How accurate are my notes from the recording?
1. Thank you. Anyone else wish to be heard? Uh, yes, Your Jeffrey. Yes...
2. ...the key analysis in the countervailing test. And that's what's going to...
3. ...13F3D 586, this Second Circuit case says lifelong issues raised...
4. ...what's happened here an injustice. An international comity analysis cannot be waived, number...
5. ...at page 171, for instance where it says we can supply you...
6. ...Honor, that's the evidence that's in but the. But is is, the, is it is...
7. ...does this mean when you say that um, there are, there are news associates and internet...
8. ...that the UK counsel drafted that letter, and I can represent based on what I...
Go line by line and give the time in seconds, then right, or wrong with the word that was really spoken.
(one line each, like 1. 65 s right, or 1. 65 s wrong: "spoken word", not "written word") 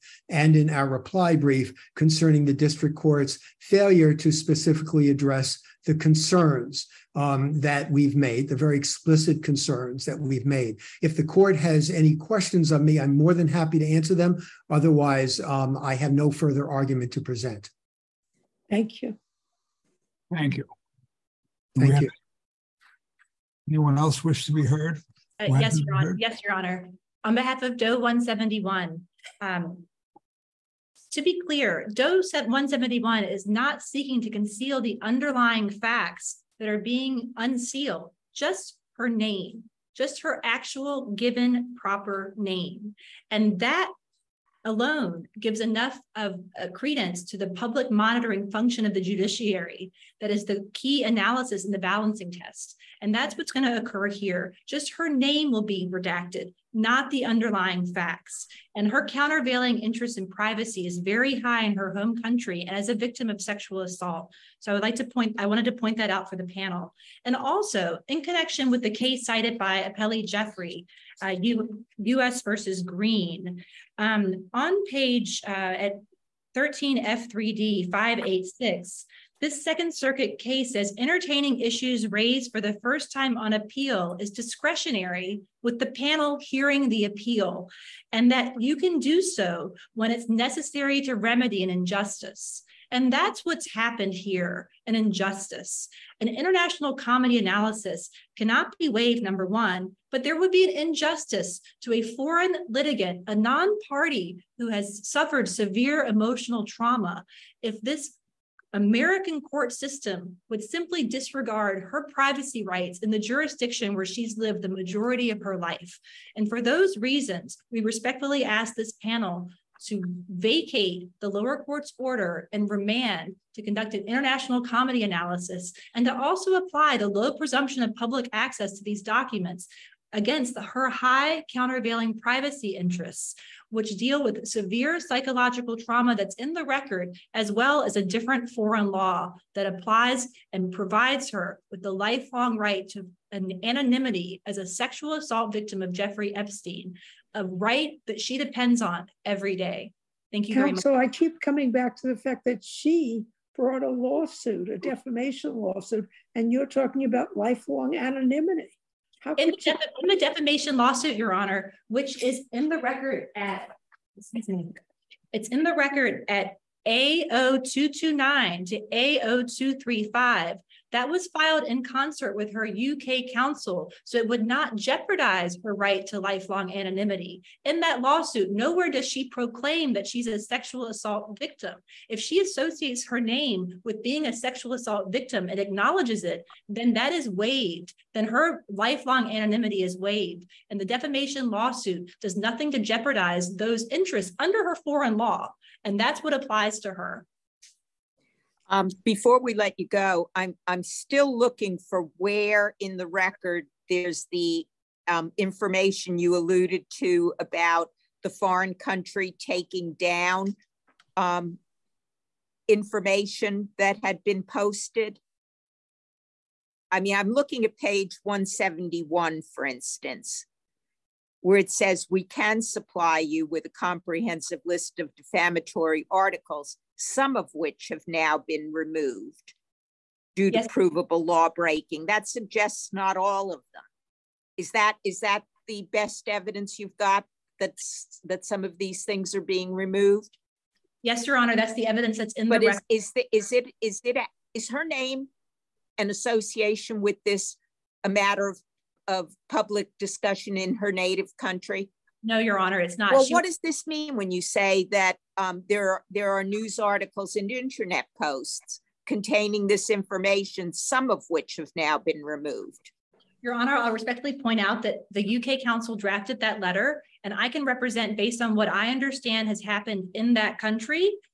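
1. 21 s wrong: "Honor", not "Jeffrey"
2. 50 s wrong: "balancing", not "countervailing"
3. 76 s wrong: "entertaining", not "lifelong"
4. 93 s right
5. 217 s right
6. 241 s right
7. 253 s wrong: "articles", not "associates"
8. 264 s right.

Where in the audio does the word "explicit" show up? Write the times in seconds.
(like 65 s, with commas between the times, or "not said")
8 s.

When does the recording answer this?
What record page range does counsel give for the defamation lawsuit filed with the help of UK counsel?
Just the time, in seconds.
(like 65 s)
166 s.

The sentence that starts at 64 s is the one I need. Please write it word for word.
So I would like to point, I wanted to point that out for the panel.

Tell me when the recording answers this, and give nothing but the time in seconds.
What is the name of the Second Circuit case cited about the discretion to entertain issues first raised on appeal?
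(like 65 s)
71 s.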